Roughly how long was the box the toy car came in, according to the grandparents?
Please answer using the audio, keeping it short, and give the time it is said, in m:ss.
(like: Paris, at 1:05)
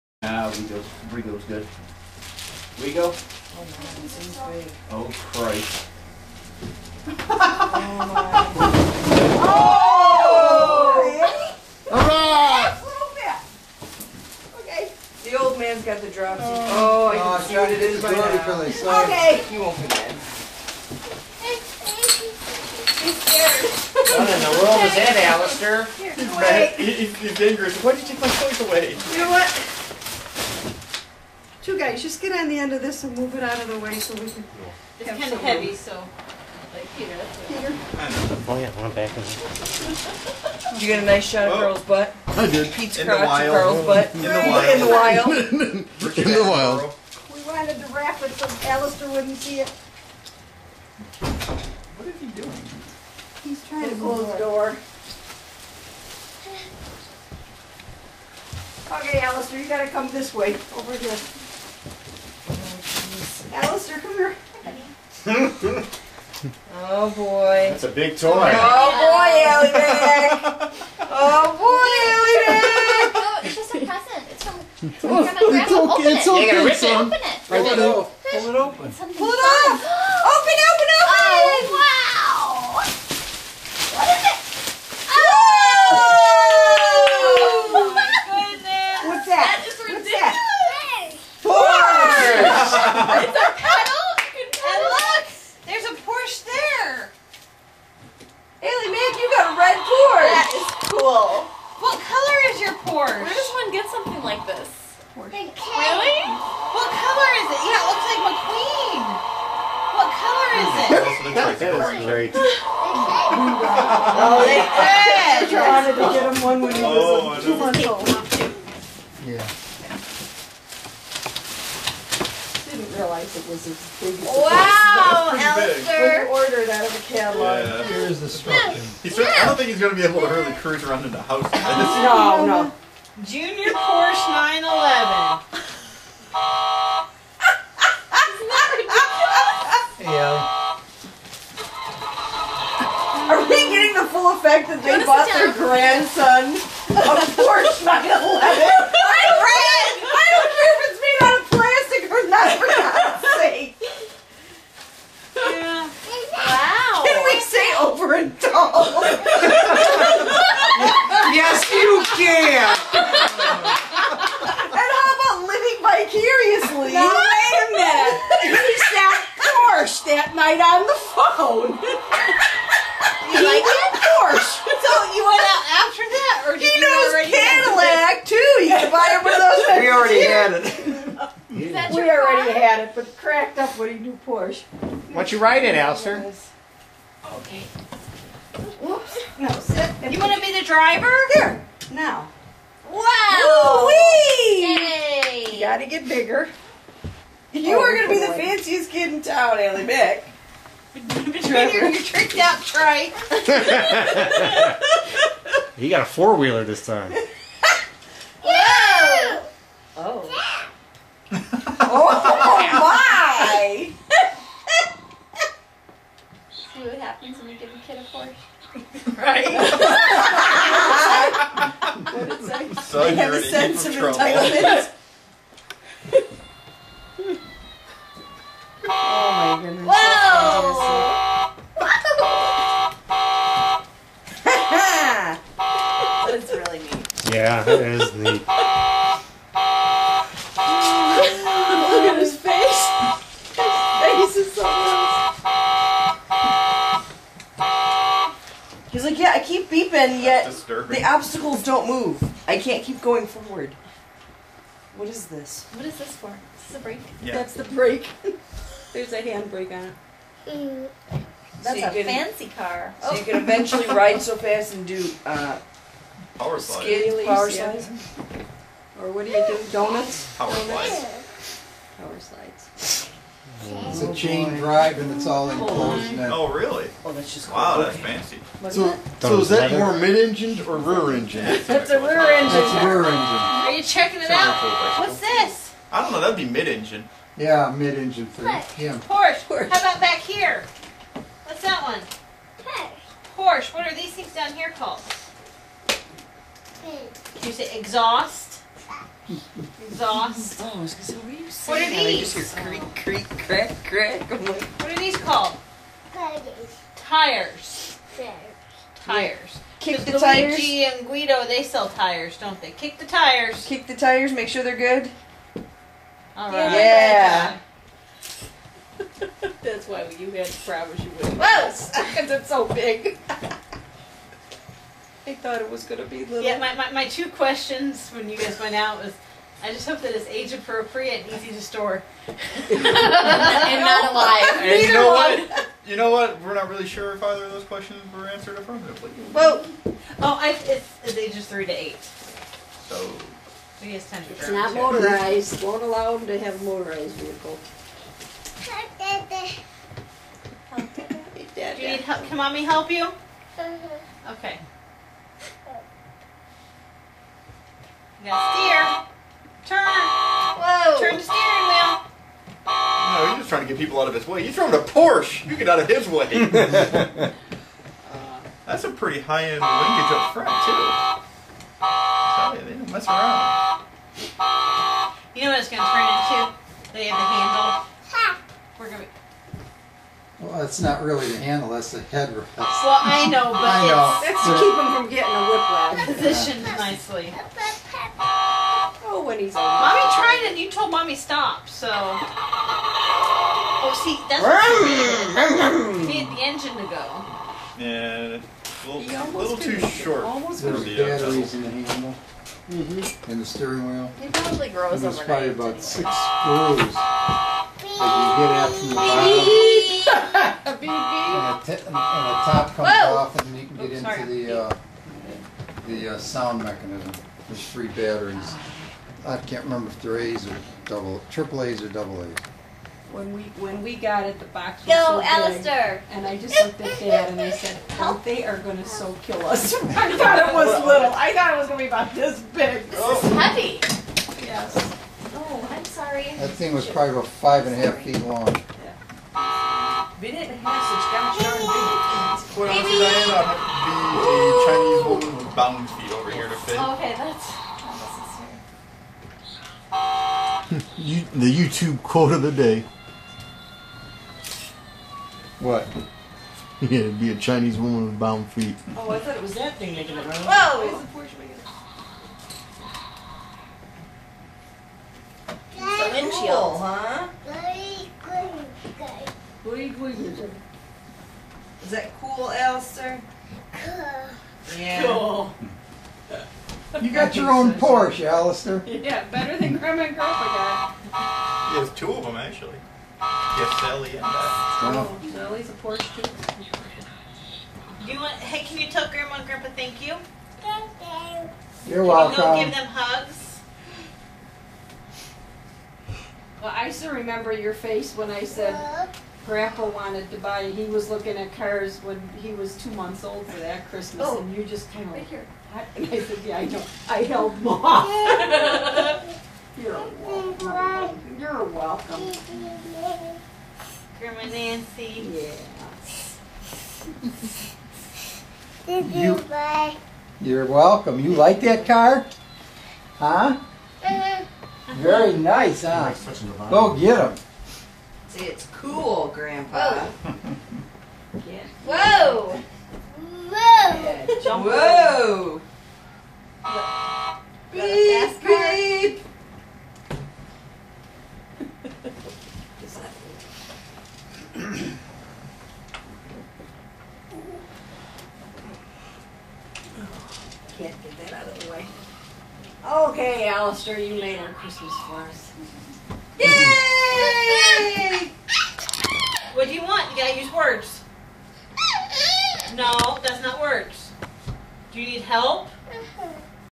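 5.5 feet, at 7:17.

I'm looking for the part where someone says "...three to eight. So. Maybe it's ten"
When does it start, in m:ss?
5:41.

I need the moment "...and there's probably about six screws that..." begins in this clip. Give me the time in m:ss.
6:44.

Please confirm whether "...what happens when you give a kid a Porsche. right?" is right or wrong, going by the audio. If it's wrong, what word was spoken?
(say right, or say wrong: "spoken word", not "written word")
right.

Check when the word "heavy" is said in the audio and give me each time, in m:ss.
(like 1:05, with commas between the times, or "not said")
0:35, 7:13.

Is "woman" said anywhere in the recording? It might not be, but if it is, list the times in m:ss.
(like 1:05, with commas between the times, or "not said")
7:25, 7:37.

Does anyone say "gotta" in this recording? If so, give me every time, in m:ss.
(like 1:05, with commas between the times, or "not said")
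0:59, 3:15, 9:20.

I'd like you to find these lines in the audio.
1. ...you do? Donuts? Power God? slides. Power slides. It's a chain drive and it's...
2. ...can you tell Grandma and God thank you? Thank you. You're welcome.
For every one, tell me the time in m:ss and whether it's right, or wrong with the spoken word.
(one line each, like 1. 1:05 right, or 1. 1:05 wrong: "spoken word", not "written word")
1. 4:29 wrong: "Donuts", not "God"
2. 8:08 wrong: "Grandpa", not "God".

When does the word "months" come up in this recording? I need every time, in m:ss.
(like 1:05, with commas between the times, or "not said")
1:57, 8:22.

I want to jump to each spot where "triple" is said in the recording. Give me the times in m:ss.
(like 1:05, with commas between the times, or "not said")
7:01.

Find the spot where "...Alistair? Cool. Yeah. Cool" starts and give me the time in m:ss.
7:52.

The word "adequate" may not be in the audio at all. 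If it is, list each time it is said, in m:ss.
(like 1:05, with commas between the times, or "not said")
not said.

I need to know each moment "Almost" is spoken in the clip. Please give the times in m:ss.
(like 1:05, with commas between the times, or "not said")
6:40.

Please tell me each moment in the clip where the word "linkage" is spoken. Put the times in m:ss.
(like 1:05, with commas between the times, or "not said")
6:09.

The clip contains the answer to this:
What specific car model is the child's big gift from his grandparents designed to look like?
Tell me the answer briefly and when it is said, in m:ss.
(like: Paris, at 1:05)
Junior Porsche 911, at 2:13.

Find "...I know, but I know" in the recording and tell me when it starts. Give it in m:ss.
6:22.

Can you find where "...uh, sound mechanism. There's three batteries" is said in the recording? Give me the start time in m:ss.
6:56.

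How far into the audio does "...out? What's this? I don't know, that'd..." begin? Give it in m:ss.
4:44.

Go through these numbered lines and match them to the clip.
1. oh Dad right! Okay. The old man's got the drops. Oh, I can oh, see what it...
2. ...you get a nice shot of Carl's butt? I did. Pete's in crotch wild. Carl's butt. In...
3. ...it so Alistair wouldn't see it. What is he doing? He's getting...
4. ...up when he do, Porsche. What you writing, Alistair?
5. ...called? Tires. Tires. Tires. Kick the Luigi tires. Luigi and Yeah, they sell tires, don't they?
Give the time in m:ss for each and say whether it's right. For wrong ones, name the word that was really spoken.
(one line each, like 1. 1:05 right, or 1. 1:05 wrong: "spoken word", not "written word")
1. 0:11 wrong: "All", not "Dad"
2. 0:40 right
3. 0:48 wrong: "trying", not "getting"
4. 3:03 right
5. 5:05 wrong: "Guido", not "Yeah".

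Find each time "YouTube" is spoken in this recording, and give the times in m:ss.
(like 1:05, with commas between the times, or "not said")
7:31.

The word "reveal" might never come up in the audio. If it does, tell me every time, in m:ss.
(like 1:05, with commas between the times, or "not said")
not said.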